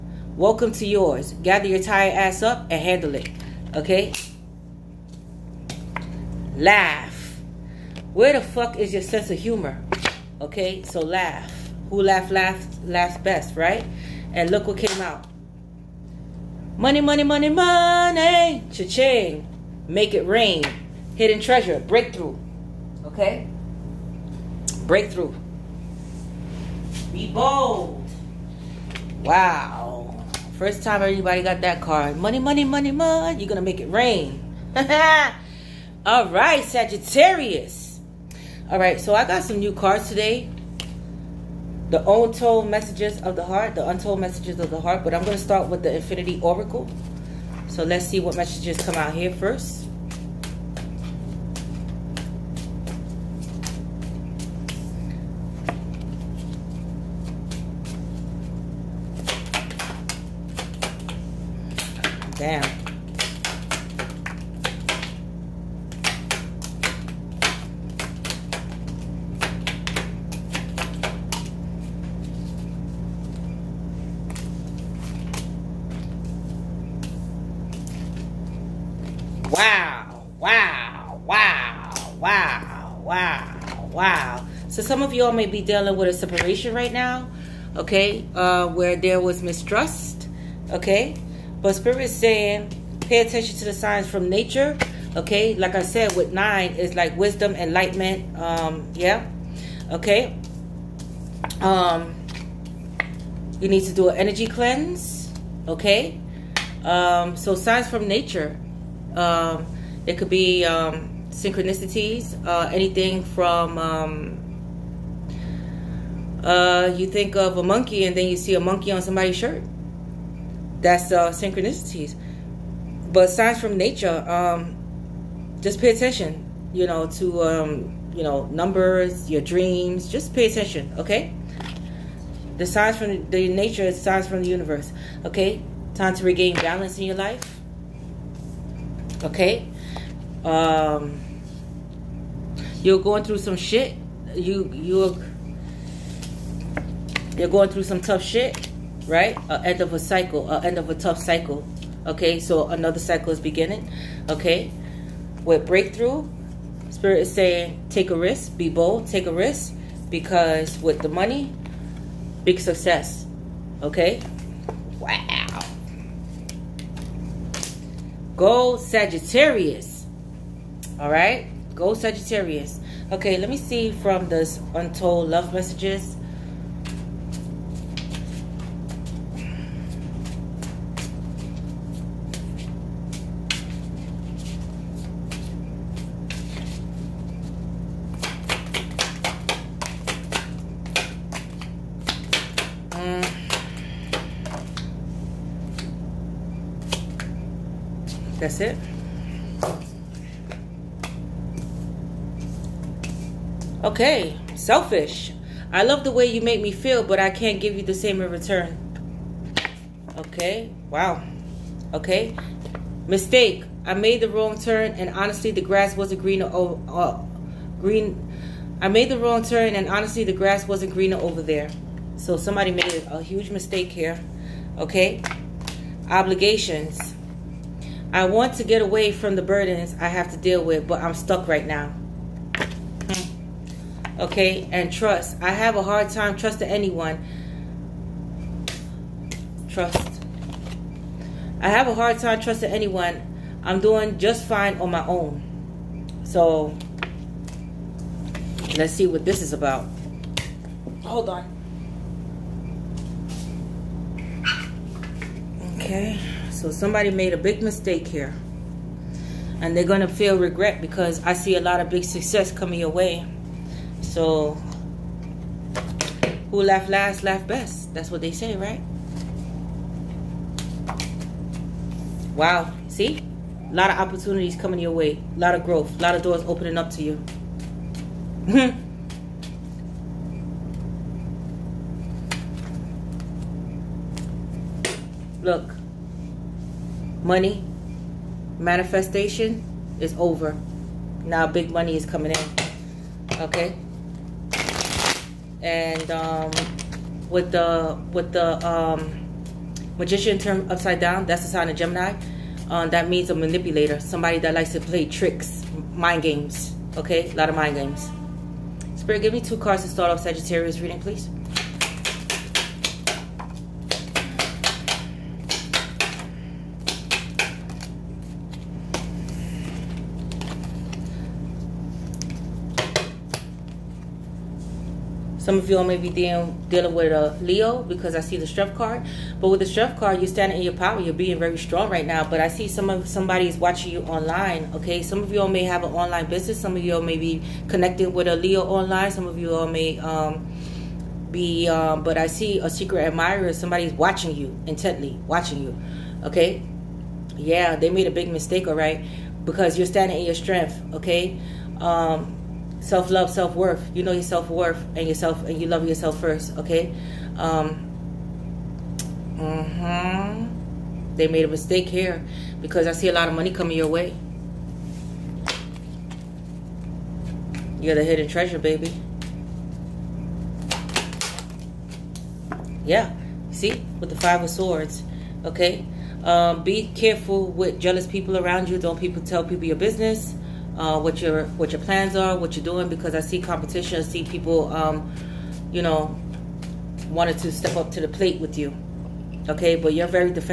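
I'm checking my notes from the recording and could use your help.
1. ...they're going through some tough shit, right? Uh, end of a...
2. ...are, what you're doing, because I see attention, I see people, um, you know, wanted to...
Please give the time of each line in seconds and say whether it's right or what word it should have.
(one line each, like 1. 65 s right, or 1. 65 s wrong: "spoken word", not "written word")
1. 147 s right
2. 382 s wrong: "competition", not "attention".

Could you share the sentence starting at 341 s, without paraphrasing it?
Um, but I see a secret admirer.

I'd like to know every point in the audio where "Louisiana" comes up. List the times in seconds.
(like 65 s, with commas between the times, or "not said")
not said.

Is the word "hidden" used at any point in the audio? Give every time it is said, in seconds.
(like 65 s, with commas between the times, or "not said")
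21 s, 368 s.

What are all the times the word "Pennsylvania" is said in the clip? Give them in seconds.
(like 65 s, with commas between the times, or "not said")
not said.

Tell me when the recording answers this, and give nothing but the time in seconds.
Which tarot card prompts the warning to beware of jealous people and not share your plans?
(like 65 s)
374 s.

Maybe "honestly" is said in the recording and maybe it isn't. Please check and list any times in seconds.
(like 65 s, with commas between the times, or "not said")
215 s, 219 s.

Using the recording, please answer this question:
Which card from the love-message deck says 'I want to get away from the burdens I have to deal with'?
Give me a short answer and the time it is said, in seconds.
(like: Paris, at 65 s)
Obligations, at 226 s.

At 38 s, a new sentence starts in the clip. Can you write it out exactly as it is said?
All right, so I got some new cards today.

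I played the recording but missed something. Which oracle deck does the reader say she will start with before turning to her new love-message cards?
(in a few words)
Infinity Oracle.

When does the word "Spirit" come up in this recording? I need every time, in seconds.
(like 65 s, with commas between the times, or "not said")
91 s, 156 s, 308 s.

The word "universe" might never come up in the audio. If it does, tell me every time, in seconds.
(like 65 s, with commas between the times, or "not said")
134 s.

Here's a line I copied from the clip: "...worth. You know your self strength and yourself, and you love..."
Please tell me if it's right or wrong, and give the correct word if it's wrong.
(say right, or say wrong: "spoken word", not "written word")
wrong: "worth", not "strength".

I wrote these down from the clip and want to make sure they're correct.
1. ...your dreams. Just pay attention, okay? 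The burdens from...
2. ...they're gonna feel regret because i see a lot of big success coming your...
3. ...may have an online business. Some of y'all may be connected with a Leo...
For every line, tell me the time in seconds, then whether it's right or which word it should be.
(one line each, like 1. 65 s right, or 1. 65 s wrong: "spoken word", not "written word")
1. 129 s wrong: "signs", not "burdens"
2. 259 s right
3. 335 s right.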